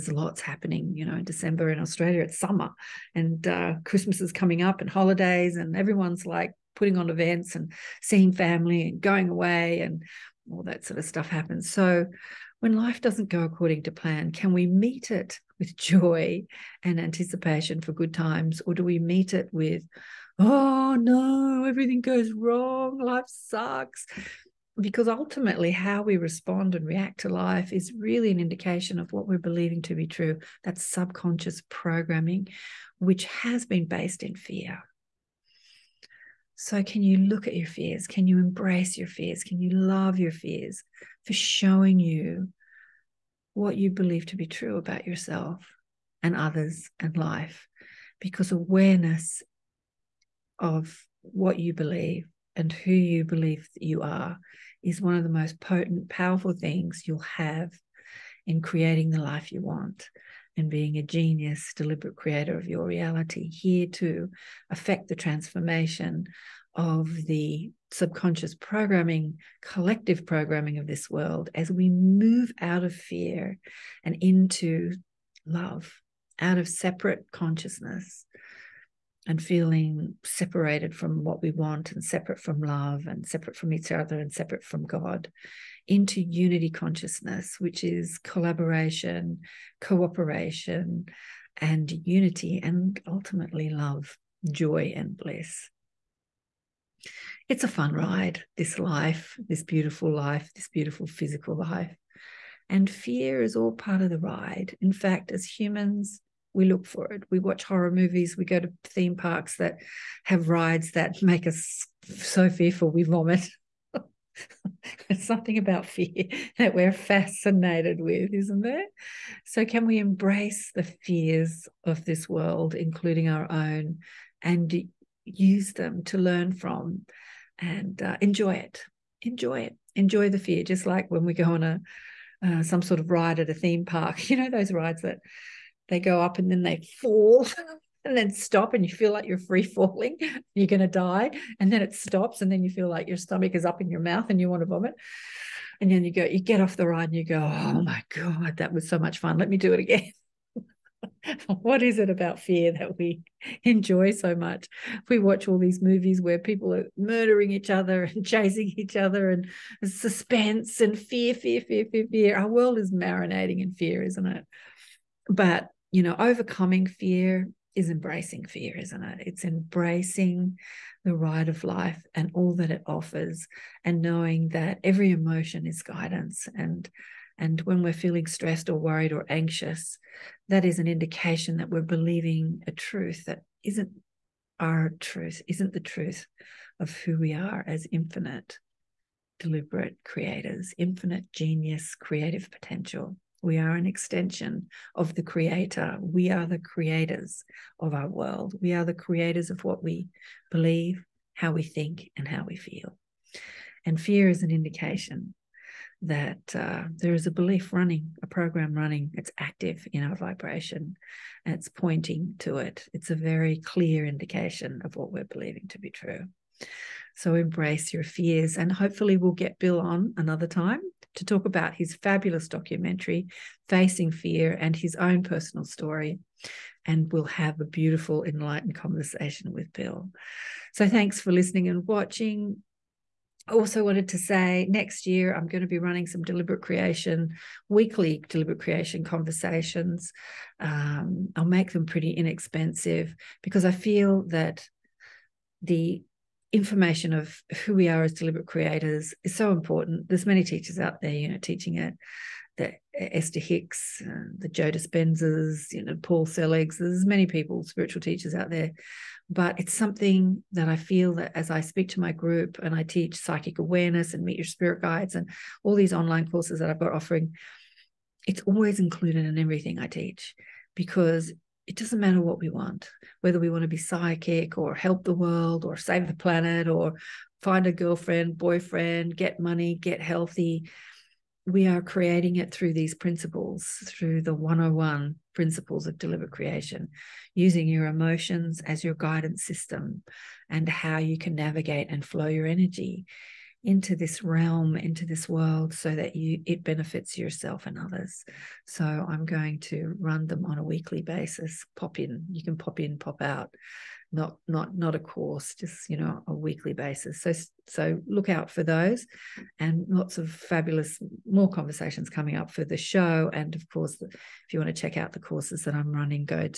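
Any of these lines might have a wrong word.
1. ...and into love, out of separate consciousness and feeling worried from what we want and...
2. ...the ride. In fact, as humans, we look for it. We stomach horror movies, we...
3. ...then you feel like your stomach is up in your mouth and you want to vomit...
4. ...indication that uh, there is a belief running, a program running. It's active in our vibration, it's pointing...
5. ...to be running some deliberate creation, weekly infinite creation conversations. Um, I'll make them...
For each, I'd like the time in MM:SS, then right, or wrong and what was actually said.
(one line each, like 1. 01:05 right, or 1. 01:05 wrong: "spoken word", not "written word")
1. 01:14 wrong: "separated", not "worried"
2. 01:44 wrong: "watch", not "stomach"
3. 02:22 right
4. 03:24 right
5. 03:55 wrong: "deliberate", not "infinite".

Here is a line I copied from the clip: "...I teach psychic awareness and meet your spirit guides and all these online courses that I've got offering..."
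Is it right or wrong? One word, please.
right.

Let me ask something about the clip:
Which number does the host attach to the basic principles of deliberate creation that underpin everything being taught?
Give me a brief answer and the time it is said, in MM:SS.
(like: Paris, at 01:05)
101, at 04:44.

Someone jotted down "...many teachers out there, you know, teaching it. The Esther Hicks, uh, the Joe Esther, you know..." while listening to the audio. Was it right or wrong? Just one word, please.
wrong.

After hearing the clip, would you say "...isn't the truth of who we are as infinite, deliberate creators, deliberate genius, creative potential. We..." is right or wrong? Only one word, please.
wrong.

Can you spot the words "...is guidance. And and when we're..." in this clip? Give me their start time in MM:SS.
02:55.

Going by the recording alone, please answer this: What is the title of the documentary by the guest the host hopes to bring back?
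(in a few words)
Facing Fear.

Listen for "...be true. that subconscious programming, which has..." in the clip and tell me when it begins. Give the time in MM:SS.
00:29.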